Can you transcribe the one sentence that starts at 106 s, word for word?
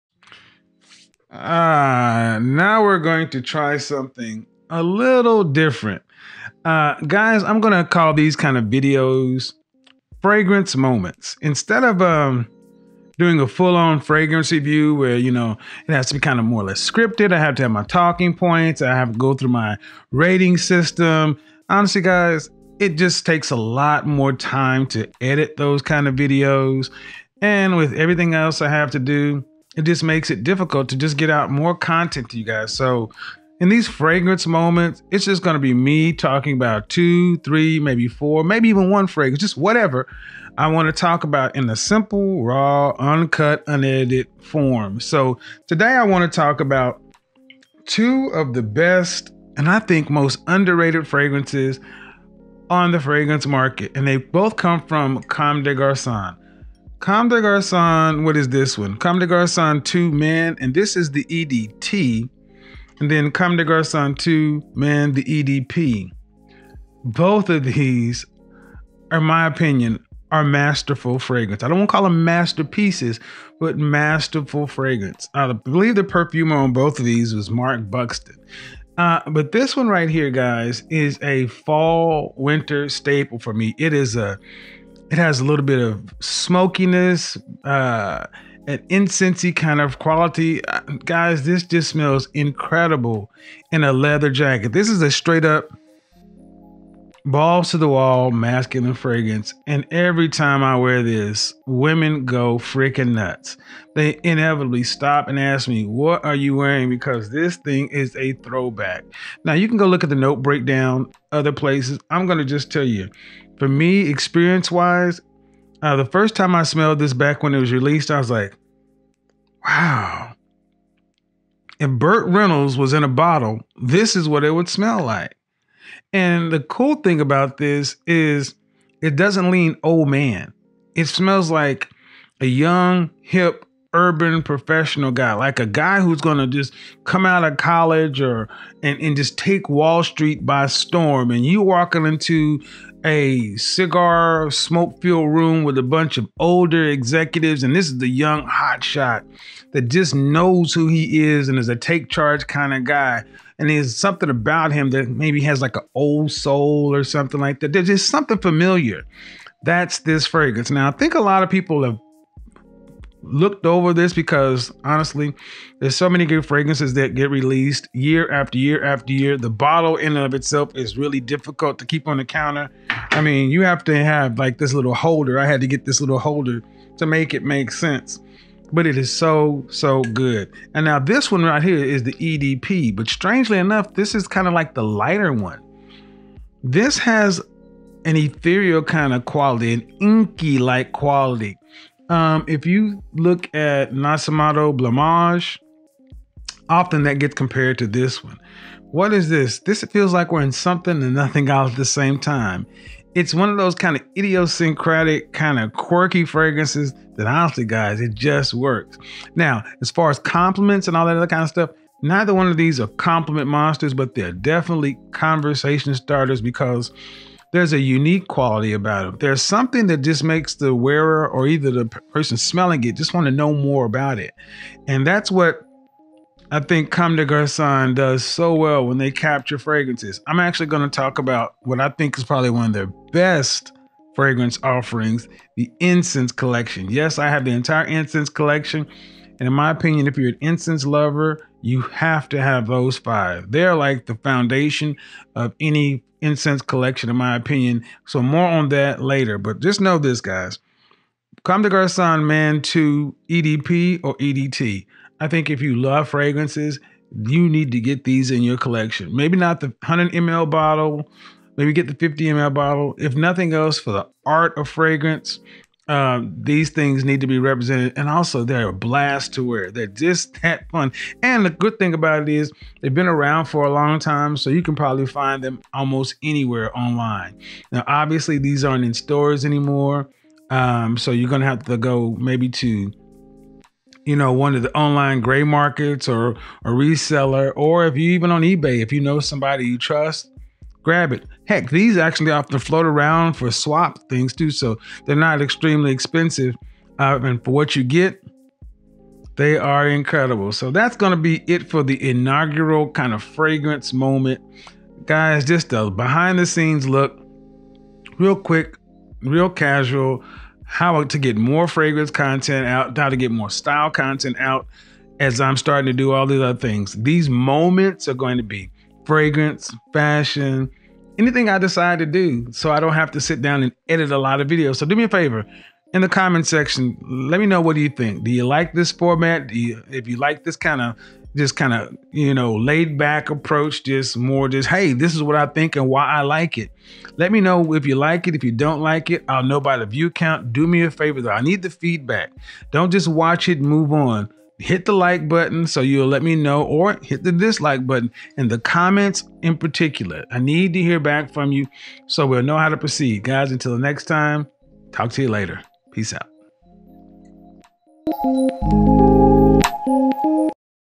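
Because this thing is a throwback.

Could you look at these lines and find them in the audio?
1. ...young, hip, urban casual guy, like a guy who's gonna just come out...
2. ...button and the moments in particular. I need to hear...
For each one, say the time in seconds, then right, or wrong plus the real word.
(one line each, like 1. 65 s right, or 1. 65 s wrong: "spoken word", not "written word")
1. 132 s wrong: "professional", not "casual"
2. 347 s wrong: "comments", not "moments".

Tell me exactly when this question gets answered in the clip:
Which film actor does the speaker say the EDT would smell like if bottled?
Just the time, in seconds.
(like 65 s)
121 s.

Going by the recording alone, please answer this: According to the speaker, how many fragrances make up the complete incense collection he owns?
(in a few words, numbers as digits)
5.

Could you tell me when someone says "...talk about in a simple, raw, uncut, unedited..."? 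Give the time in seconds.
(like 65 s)
40 s.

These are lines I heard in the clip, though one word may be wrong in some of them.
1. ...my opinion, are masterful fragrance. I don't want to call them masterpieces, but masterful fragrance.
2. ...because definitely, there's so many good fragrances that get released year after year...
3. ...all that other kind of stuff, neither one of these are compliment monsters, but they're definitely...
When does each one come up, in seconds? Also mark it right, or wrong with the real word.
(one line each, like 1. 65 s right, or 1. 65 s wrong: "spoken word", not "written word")
1. 69 s right
2. 164 s wrong: "honestly", not "definitely"
3. 210 s right.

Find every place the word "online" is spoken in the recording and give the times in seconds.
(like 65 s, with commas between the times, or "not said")
276 s, 284 s.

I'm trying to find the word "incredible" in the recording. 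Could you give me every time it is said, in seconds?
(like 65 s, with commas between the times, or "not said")
92 s, 299 s.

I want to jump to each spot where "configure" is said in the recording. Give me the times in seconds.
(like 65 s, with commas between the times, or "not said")
not said.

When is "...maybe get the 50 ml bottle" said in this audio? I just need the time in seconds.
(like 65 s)
261 s.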